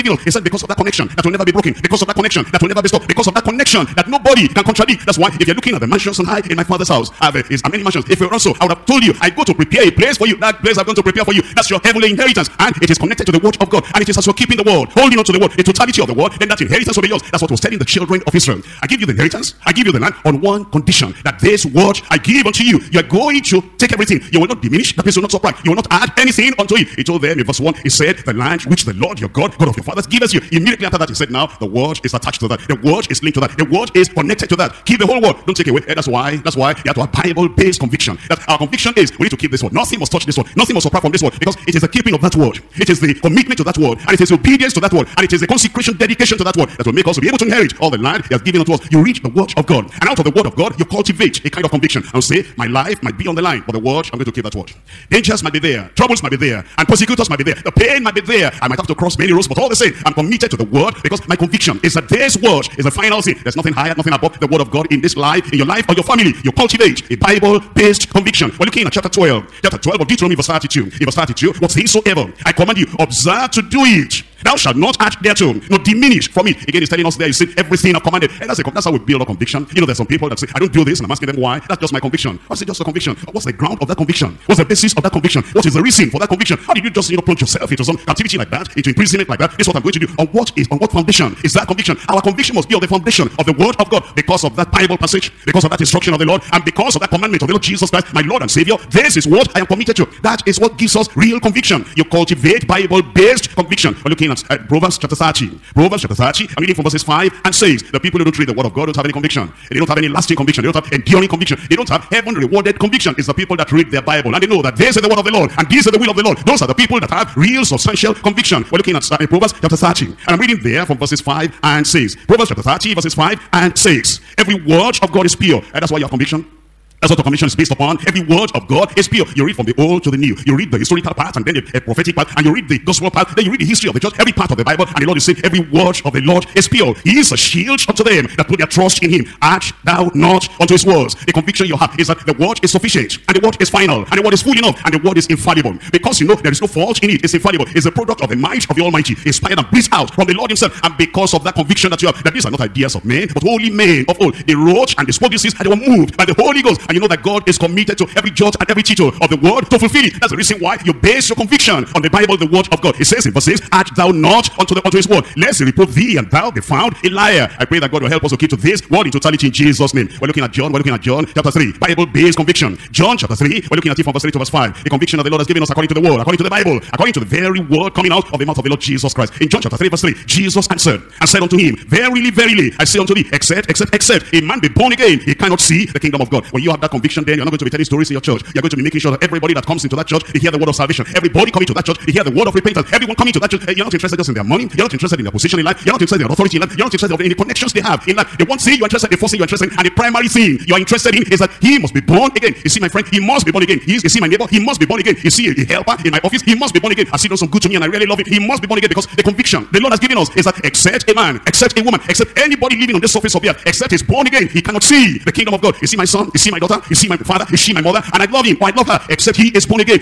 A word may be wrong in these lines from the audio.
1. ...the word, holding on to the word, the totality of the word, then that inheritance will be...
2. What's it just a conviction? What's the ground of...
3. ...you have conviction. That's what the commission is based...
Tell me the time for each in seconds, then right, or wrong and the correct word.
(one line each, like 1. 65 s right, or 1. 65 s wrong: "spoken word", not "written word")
1. 14 s right
2. 82 s right
3. 125 s right.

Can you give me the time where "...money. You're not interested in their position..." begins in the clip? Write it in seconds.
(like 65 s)
194 s.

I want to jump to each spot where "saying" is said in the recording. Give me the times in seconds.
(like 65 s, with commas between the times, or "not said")
77 s, 135 s.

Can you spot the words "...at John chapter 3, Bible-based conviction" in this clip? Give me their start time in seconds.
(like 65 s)
170 s.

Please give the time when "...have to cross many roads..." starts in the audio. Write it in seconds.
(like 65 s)
58 s.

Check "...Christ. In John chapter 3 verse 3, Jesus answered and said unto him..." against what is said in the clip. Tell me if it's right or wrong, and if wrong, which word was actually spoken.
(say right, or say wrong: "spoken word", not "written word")
right.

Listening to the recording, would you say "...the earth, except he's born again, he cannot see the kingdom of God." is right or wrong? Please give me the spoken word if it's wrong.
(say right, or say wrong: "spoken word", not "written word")
right.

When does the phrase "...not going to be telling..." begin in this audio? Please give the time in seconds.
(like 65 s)
187 s.